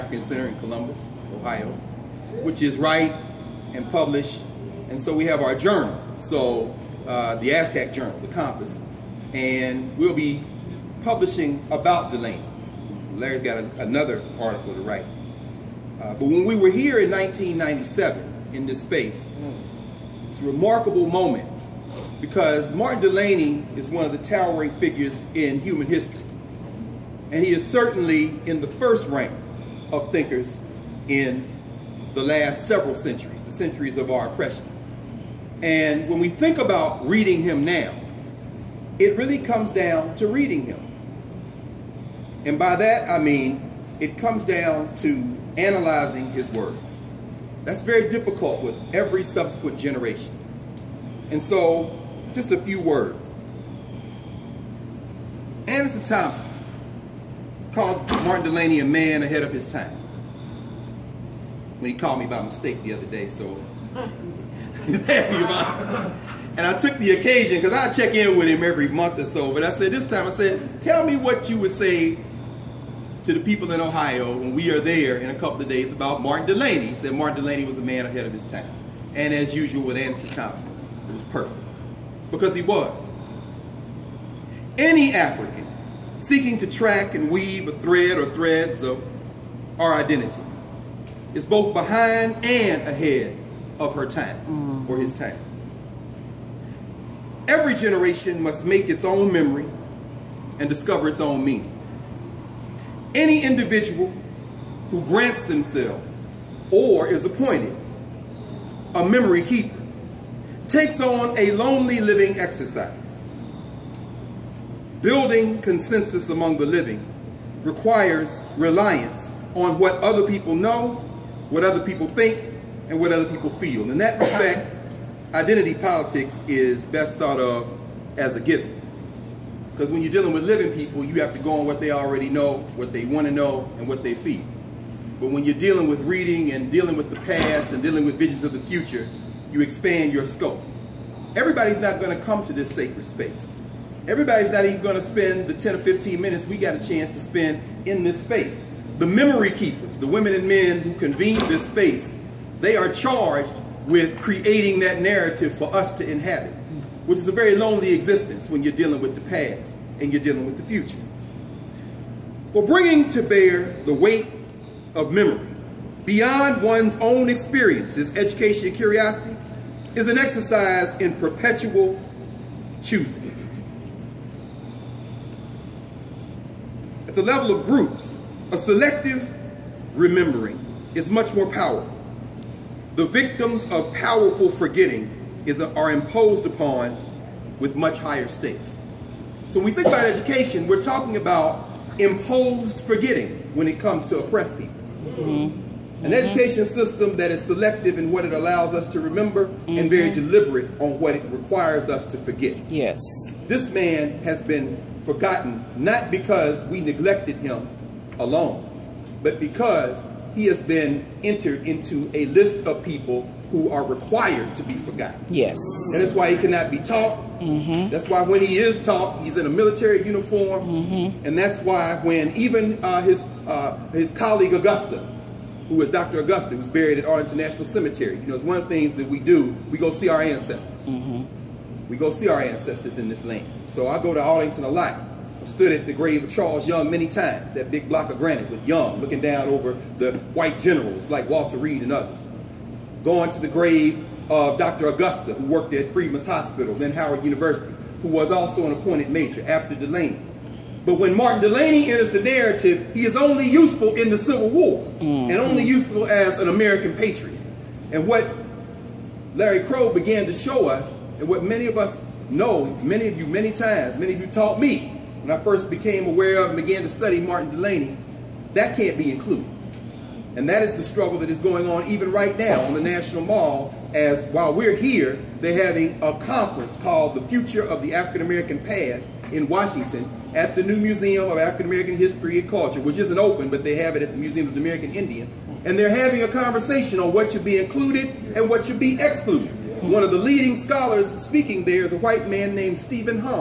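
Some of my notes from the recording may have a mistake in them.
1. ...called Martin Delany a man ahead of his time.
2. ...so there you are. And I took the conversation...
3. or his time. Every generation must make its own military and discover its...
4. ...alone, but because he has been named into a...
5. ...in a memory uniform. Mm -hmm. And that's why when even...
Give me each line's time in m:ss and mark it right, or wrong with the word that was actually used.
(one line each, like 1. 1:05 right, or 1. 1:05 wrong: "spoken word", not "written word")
1. 0:57 right
2. 1:03 wrong: "occasion", not "conversation"
3. 1:34 wrong: "memory", not "military"
4. 3:28 wrong: "entered", not "named"
5. 3:39 wrong: "military", not "memory".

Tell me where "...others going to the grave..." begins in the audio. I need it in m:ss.
4:01.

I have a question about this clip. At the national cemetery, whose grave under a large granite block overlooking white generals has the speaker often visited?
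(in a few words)
Charles Young.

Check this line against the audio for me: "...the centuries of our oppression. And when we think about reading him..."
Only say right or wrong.
right.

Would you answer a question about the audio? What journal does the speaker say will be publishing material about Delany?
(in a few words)
The Compass.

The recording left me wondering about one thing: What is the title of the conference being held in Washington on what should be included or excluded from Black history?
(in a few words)
The Future of the African American Past.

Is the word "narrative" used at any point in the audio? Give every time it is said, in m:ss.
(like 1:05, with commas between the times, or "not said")
2:35, 4:12.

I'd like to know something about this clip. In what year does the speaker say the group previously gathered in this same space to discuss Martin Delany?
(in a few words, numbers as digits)
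1997.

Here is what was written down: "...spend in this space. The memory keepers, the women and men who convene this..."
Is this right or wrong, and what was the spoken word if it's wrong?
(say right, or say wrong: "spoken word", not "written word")
right.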